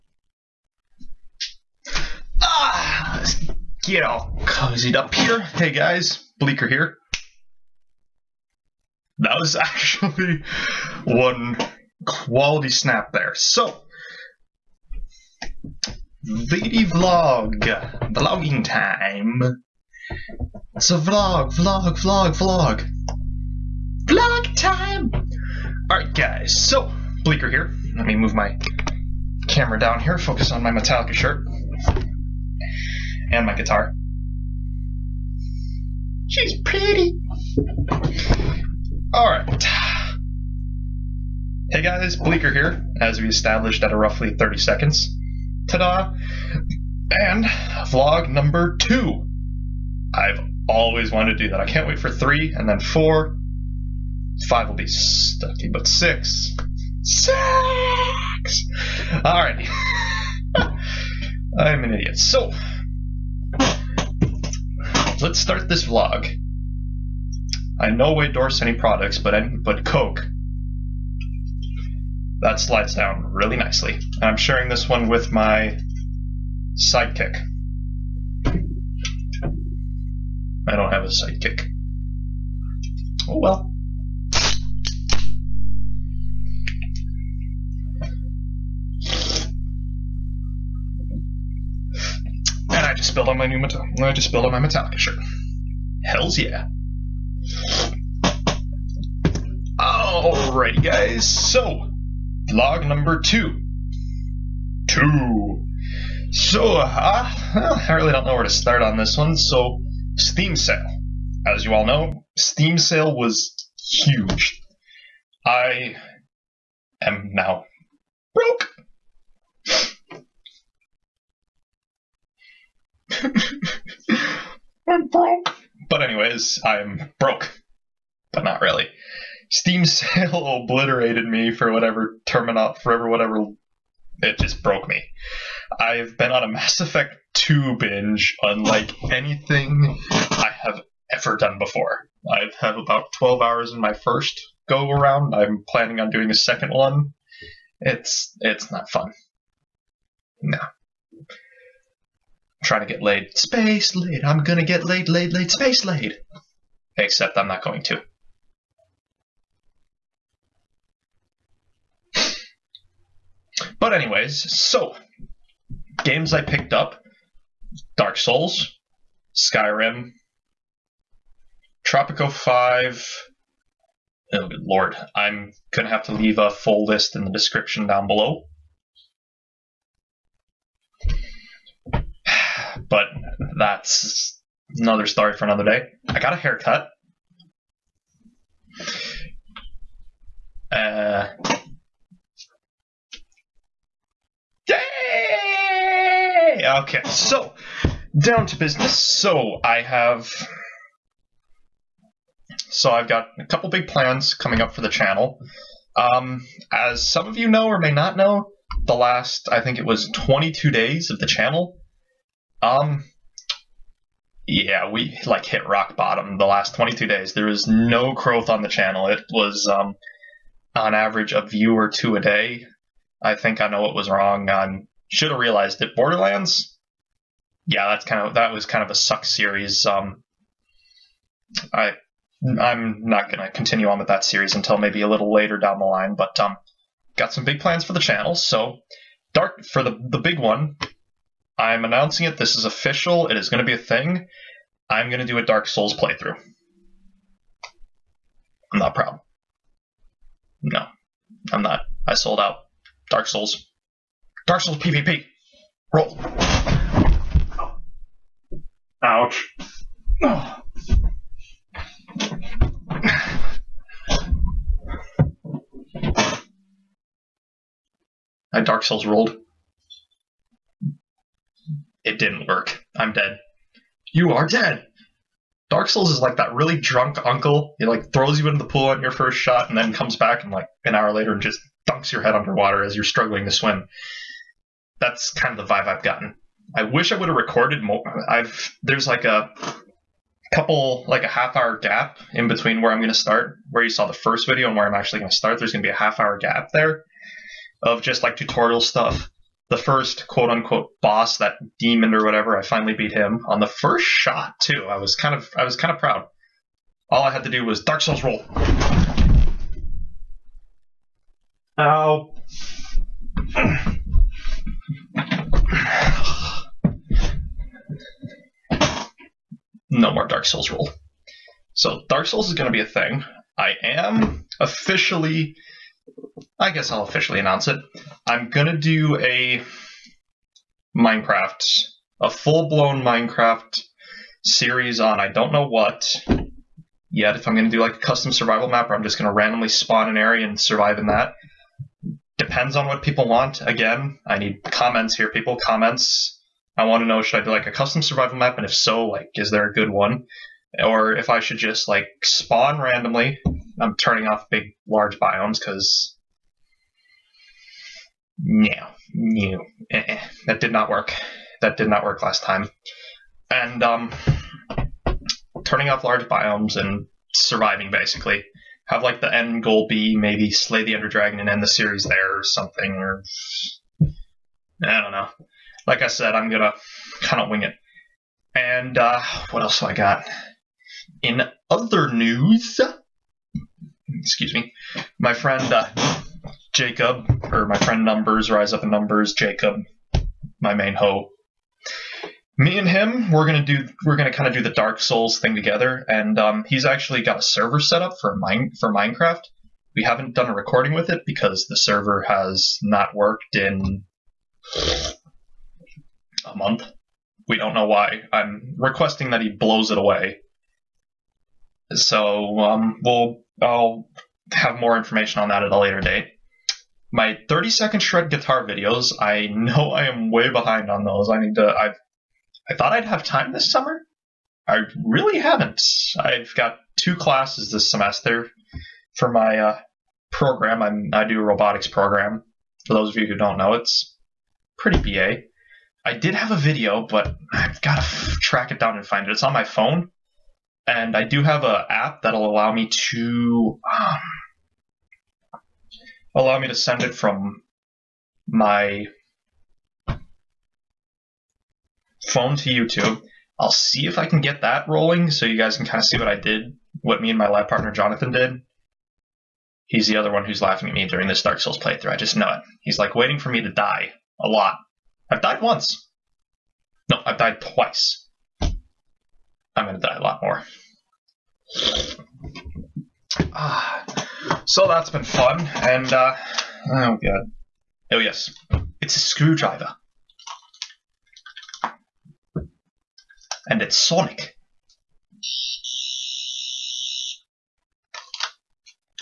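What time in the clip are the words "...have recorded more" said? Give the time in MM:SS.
04:47.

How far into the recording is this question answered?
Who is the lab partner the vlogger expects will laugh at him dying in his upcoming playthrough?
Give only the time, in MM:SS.
07:37.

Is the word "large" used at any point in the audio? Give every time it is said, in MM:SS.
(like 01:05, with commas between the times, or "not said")
05:54, 06:06.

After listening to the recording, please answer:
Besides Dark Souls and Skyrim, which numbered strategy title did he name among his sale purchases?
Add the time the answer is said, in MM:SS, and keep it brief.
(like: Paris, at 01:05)
Tropico 5, at 02:51.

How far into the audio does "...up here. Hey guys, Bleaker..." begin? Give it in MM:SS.
00:04.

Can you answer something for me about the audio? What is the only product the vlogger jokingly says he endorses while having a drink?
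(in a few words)
Coke.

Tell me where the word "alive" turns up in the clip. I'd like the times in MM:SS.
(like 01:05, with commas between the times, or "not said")
not said.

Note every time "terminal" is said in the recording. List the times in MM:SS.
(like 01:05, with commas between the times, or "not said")
02:12.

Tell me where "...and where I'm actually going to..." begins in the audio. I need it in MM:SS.
04:54.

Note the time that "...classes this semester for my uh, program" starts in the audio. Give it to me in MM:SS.
07:07.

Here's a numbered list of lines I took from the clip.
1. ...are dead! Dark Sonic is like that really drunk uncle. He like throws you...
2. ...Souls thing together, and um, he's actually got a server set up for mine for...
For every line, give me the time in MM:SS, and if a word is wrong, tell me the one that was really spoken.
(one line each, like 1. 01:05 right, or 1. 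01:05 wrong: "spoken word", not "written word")
1. 04:34 wrong: "Souls", not "Sonic"
2. 06:34 right.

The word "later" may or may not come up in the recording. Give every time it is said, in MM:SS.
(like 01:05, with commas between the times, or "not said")
03:55, 04:41, 06:55.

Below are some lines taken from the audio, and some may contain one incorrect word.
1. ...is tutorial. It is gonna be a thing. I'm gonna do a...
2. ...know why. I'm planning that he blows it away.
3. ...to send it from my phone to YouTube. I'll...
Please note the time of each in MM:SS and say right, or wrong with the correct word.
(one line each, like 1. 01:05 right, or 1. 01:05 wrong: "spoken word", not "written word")
1. 04:02 wrong: "official", not "tutorial"
2. 06:47 wrong: "requesting", not "planning"
3. 07:26 right.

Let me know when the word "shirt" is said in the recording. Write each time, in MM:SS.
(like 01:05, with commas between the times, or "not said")
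00:31, 01:34.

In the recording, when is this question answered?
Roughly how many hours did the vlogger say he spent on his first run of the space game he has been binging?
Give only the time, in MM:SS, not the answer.
02:23.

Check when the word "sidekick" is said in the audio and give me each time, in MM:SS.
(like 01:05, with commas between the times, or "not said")
01:16, 01:21.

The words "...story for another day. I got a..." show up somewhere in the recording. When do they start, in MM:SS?
03:05.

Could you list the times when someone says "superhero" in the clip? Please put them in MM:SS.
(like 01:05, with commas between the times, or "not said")
not said.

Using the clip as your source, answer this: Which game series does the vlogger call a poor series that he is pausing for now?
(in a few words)
Borderlands.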